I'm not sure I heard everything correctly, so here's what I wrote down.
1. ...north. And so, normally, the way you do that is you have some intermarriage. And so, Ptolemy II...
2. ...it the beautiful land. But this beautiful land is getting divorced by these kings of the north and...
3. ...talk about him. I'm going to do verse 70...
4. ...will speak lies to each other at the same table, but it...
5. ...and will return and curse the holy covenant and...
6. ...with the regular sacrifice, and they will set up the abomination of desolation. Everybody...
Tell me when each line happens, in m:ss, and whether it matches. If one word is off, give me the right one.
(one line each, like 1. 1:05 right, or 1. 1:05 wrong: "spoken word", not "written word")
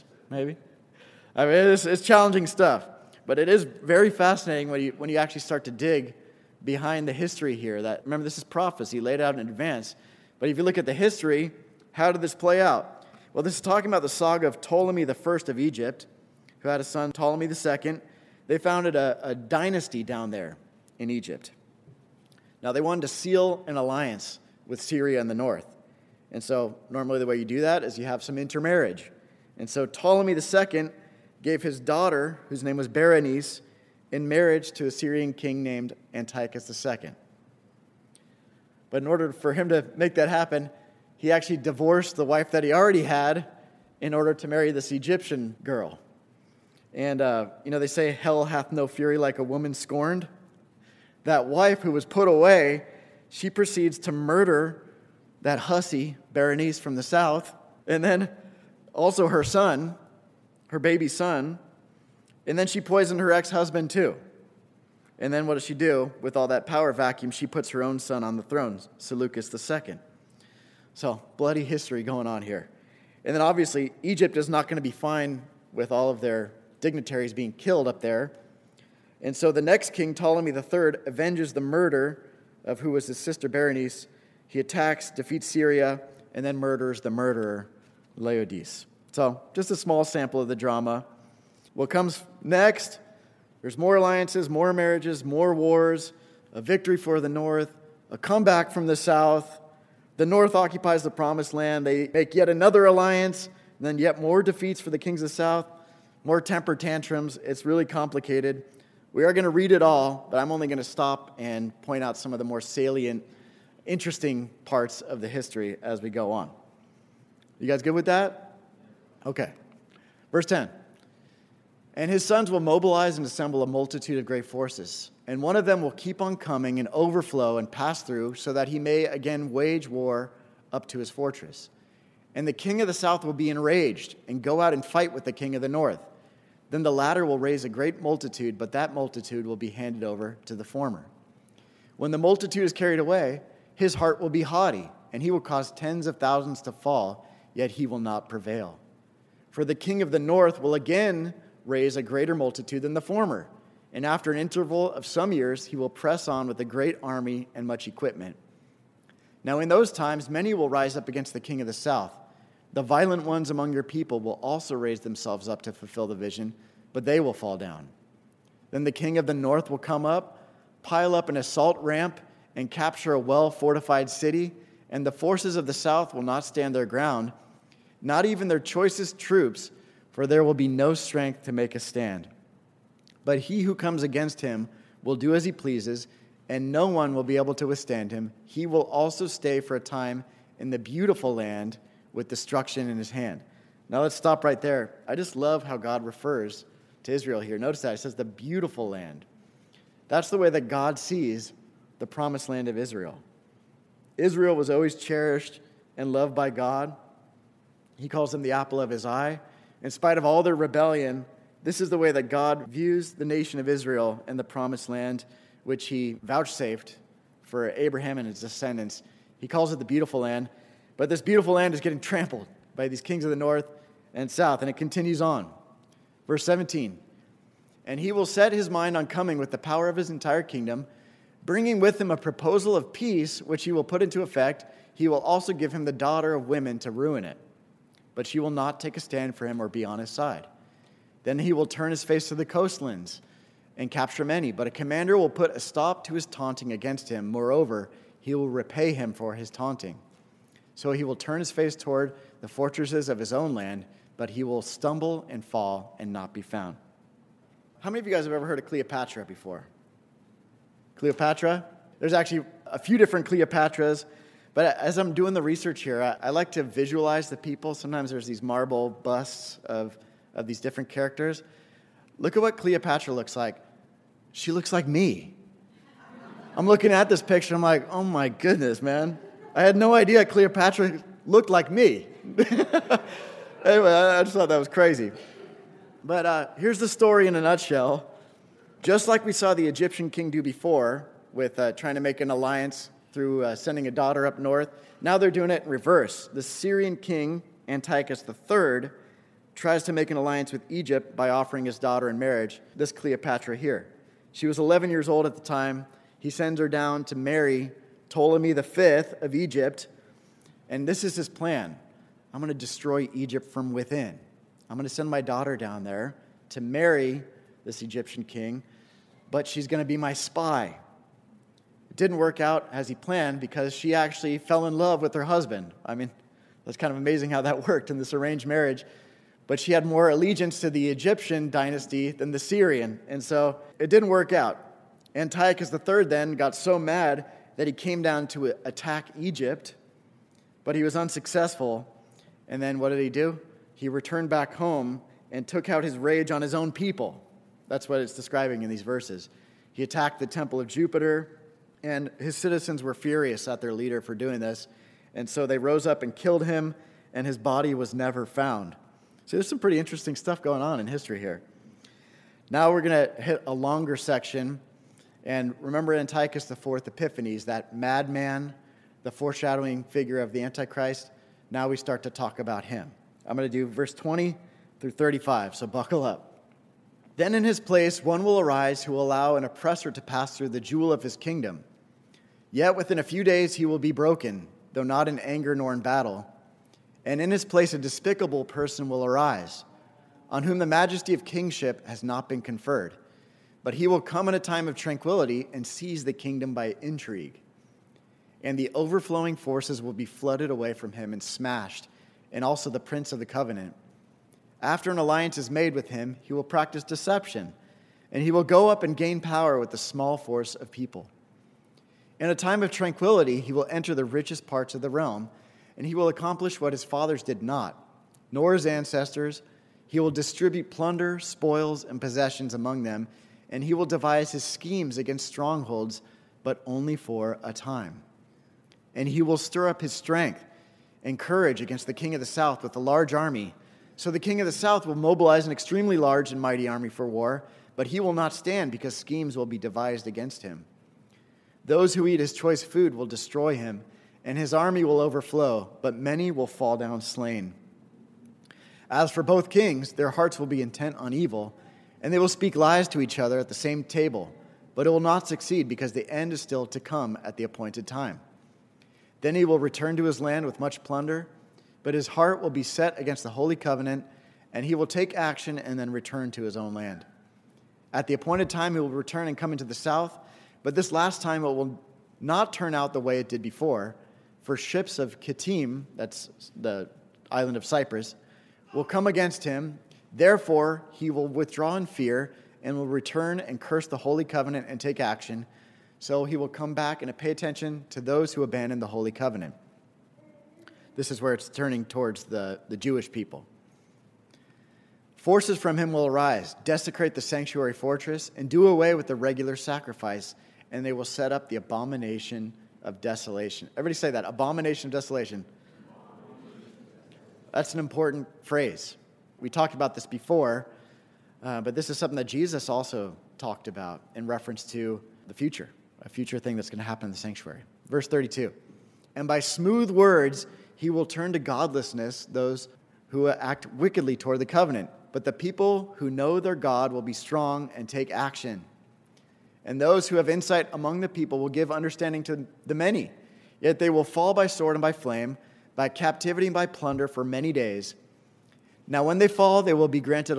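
1. 0:25 right
2. 3:39 wrong: "trampled", not "divorced"
3. 6:12 wrong: "20", not "70"
4. 7:32 right
5. 8:02 right
6. 8:18 right.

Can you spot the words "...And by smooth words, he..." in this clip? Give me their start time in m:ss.
8:39.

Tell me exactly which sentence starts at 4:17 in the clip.
How many of you guys have ever heard of Cleopatra before?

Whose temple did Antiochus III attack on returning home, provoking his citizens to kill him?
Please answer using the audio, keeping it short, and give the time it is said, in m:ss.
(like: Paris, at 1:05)
Jupiter, at 5:50.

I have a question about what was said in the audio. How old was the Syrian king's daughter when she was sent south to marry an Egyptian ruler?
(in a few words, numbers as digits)
11.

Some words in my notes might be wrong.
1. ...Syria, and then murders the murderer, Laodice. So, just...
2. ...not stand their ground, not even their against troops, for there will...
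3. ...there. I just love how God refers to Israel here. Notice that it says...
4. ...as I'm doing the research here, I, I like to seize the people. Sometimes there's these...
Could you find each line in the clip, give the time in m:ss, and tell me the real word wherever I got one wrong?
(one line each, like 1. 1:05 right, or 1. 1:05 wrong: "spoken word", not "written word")
1. 1:25 right
2. 2:56 wrong: "choicest", not "against"
3. 3:14 right
4. 4:24 wrong: "visualize", not "seize".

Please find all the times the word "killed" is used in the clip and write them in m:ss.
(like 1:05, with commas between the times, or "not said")
1:17, 5:56.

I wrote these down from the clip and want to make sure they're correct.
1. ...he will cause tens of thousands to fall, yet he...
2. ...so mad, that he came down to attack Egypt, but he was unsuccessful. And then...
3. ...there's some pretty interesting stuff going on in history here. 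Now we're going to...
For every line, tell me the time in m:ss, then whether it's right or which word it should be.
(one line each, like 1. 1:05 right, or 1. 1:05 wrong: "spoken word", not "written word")
1. 2:25 right
2. 5:36 right
3. 5:59 right.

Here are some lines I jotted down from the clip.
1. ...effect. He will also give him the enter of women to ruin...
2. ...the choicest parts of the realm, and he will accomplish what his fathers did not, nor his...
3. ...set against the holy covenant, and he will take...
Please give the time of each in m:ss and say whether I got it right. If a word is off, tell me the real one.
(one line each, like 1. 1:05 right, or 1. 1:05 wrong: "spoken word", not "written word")
1. 3:54 wrong: "daughter", not "enter"
2. 6:53 wrong: "richest", not "choicest"
3. 7:42 right.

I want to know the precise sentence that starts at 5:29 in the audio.
But she had more allegiance to the Egyptian dynasty than the Syrian.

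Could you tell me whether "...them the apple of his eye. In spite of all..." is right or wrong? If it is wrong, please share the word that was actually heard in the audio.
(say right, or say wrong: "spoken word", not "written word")
right.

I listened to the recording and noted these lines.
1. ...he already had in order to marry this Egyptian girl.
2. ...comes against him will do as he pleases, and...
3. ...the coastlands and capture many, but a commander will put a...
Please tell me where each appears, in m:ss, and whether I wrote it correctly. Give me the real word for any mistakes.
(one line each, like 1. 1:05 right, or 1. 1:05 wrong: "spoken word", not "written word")
1. 0:42 right
2. 3:03 right
3. 4:02 right.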